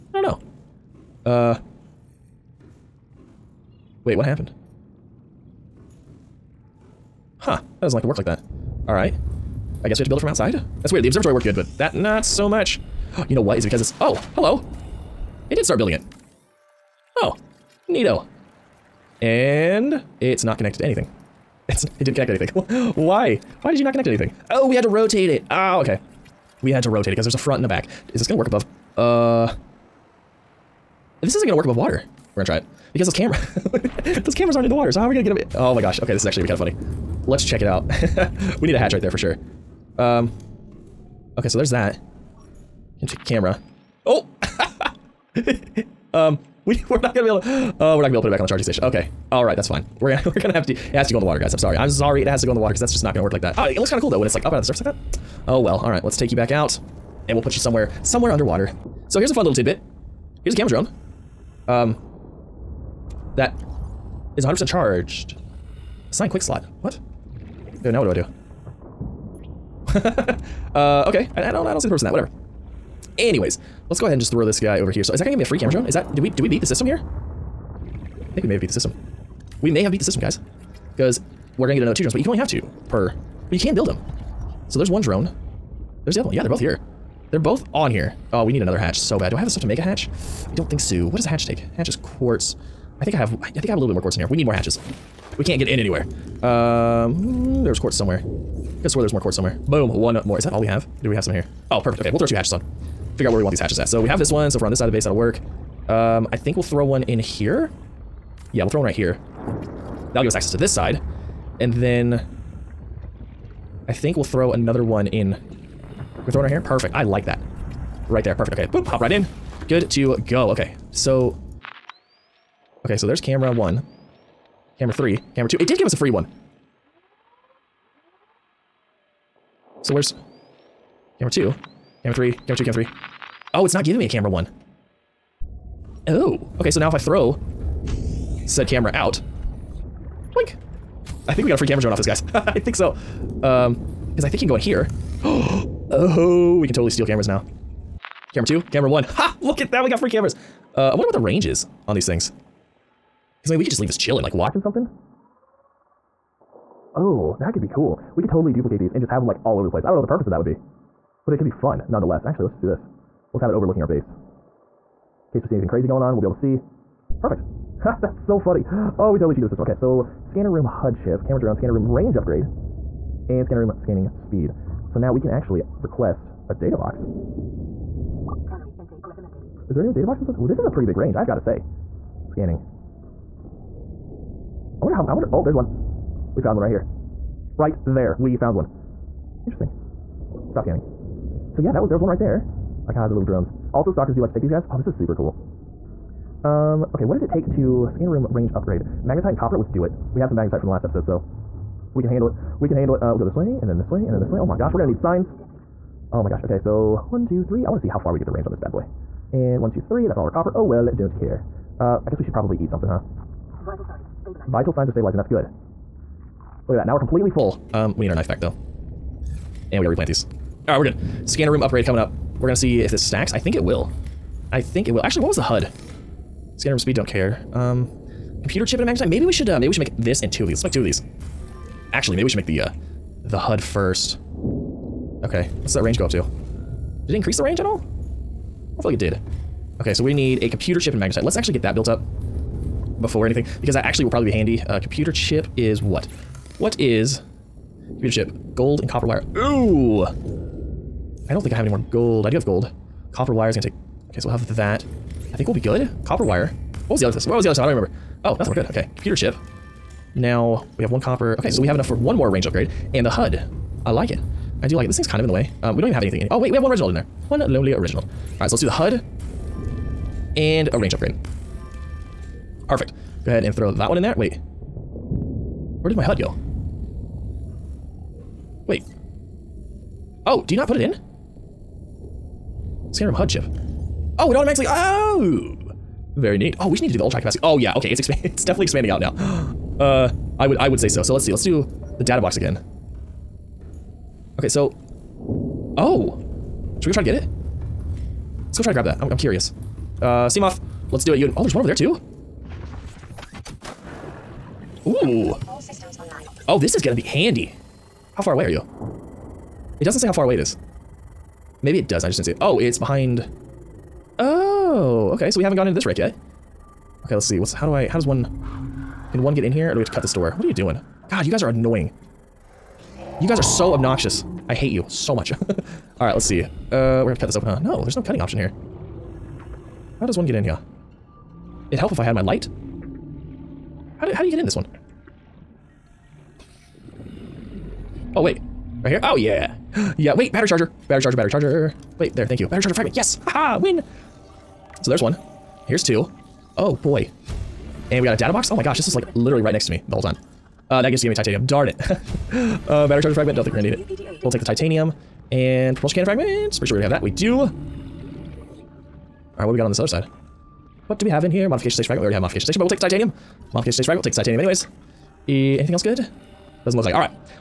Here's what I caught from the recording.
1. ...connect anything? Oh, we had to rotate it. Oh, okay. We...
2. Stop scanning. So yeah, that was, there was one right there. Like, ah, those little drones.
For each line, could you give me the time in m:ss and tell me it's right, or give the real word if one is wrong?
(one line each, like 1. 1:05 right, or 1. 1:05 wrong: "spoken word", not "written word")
1. 0:23 right
2. 3:10 right.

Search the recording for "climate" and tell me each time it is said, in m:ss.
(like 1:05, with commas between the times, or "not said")
not said.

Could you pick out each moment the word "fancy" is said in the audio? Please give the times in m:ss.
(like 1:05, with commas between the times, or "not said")
not said.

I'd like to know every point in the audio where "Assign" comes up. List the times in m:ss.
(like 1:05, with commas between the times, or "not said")
1:06.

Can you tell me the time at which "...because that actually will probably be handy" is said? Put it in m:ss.
4:03.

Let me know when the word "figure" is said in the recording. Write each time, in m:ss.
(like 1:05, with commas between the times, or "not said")
1:43.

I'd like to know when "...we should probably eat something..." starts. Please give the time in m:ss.
3:32.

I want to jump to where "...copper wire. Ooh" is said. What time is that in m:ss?
4:08.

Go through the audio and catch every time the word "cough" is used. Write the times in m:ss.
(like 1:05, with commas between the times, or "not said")
not said.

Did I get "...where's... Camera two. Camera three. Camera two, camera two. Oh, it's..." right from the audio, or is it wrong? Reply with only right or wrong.
wrong.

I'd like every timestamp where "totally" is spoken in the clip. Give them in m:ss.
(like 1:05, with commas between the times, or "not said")
2:26, 2:38, 2:49.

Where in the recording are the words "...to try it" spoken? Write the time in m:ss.
0:32.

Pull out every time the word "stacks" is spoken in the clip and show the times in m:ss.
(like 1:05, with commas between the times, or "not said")
3:43.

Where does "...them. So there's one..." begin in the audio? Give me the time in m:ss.
1:23.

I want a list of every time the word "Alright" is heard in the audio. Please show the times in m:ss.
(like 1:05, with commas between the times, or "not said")
0:08, 0:49, 0:55, 3:40, 5:26, 5:59.